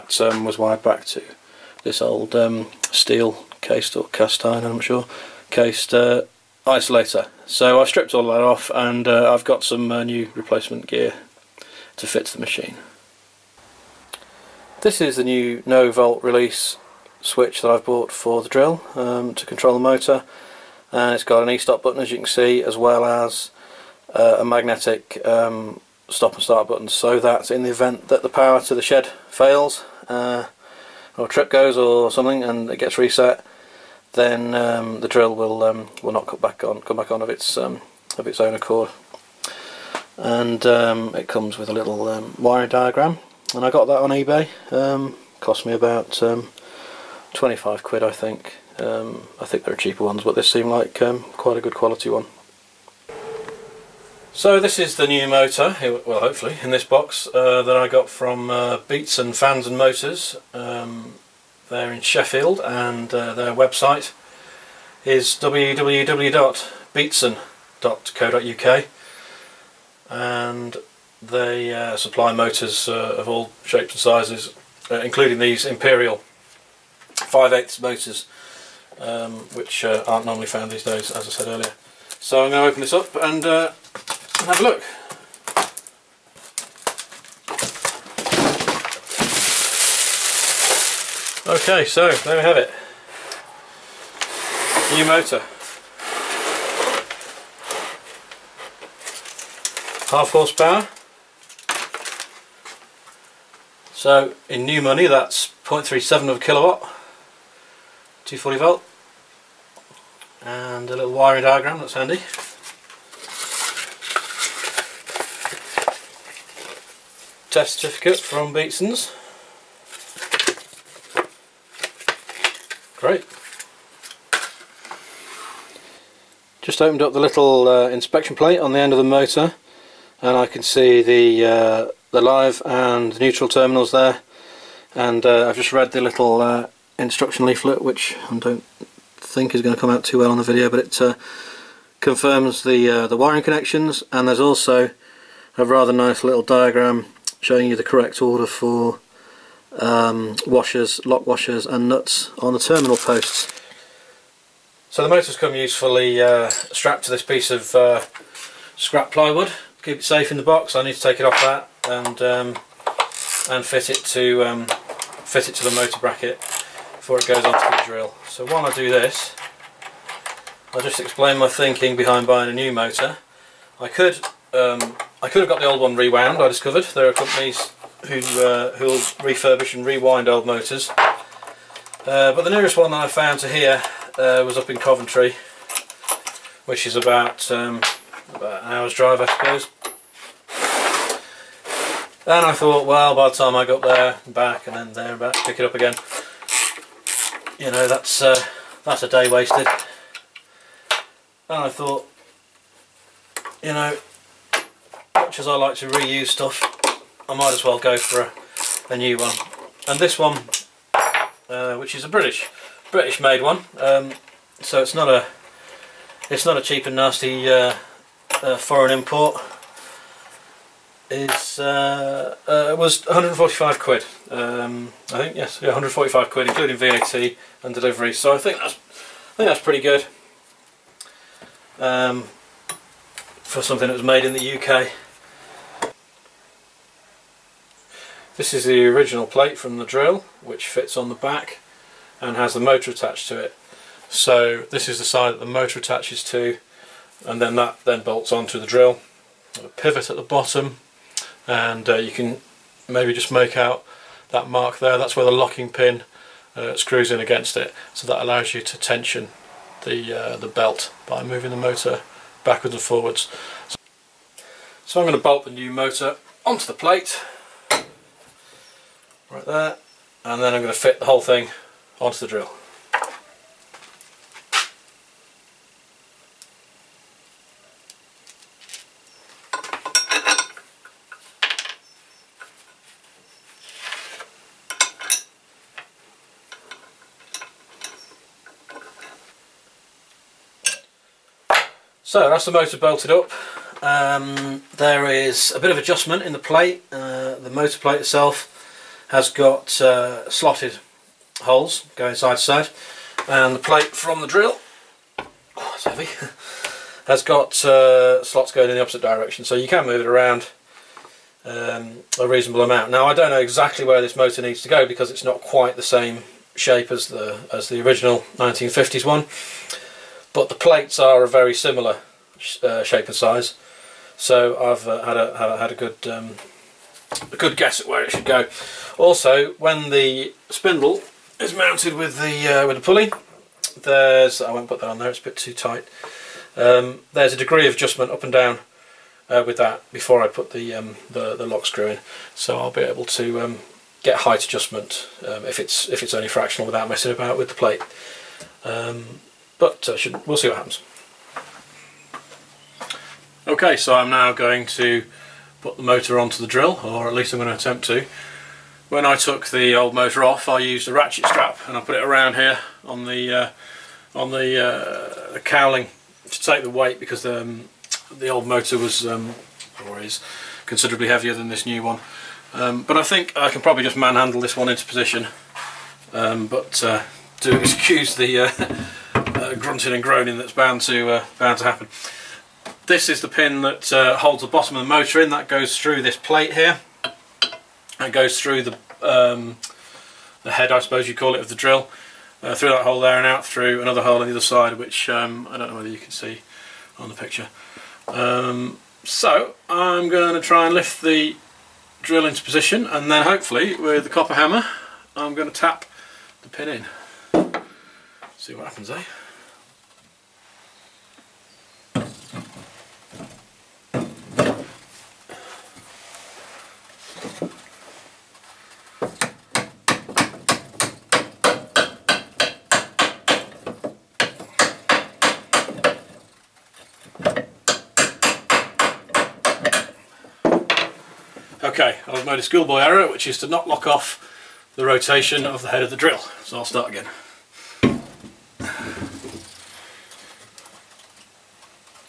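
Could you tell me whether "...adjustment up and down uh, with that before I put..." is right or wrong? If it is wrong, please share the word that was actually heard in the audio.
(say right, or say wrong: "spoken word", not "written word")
right.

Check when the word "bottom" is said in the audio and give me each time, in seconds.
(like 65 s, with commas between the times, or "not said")
250 s, 384 s.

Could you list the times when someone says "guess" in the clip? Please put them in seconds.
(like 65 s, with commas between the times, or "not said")
327 s.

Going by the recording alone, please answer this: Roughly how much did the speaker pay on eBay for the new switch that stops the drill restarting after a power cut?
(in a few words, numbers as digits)
£25.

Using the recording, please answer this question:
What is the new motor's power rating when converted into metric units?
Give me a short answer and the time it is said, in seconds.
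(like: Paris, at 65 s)
0.37 kilowatts, at 105 s.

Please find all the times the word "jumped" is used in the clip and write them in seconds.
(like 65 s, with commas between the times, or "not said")
not said.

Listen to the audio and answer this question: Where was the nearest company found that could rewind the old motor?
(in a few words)
Coventry.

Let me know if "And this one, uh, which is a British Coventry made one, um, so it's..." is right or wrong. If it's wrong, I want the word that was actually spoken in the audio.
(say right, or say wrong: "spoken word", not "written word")
wrong: "British", not "Coventry".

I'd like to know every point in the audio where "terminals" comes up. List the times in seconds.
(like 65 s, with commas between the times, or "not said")
133 s, 152 s.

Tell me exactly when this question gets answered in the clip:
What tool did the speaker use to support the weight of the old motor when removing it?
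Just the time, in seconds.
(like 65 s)
360 s.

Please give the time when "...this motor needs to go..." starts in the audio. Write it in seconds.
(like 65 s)
314 s.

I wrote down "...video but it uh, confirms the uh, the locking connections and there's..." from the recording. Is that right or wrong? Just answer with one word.
wrong.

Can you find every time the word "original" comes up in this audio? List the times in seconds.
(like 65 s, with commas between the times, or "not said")
238 s, 317 s.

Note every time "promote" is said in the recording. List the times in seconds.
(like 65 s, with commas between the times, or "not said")
not said.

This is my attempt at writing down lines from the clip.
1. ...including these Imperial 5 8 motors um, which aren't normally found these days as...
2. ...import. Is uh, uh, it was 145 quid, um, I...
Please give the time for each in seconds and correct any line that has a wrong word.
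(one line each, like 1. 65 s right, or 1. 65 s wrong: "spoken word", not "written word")
1. 74 s right
2. 218 s right.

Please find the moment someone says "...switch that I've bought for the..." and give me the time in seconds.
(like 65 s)
17 s.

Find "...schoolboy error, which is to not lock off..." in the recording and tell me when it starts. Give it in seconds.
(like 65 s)
432 s.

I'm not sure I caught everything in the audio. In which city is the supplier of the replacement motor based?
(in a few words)
Sheffield.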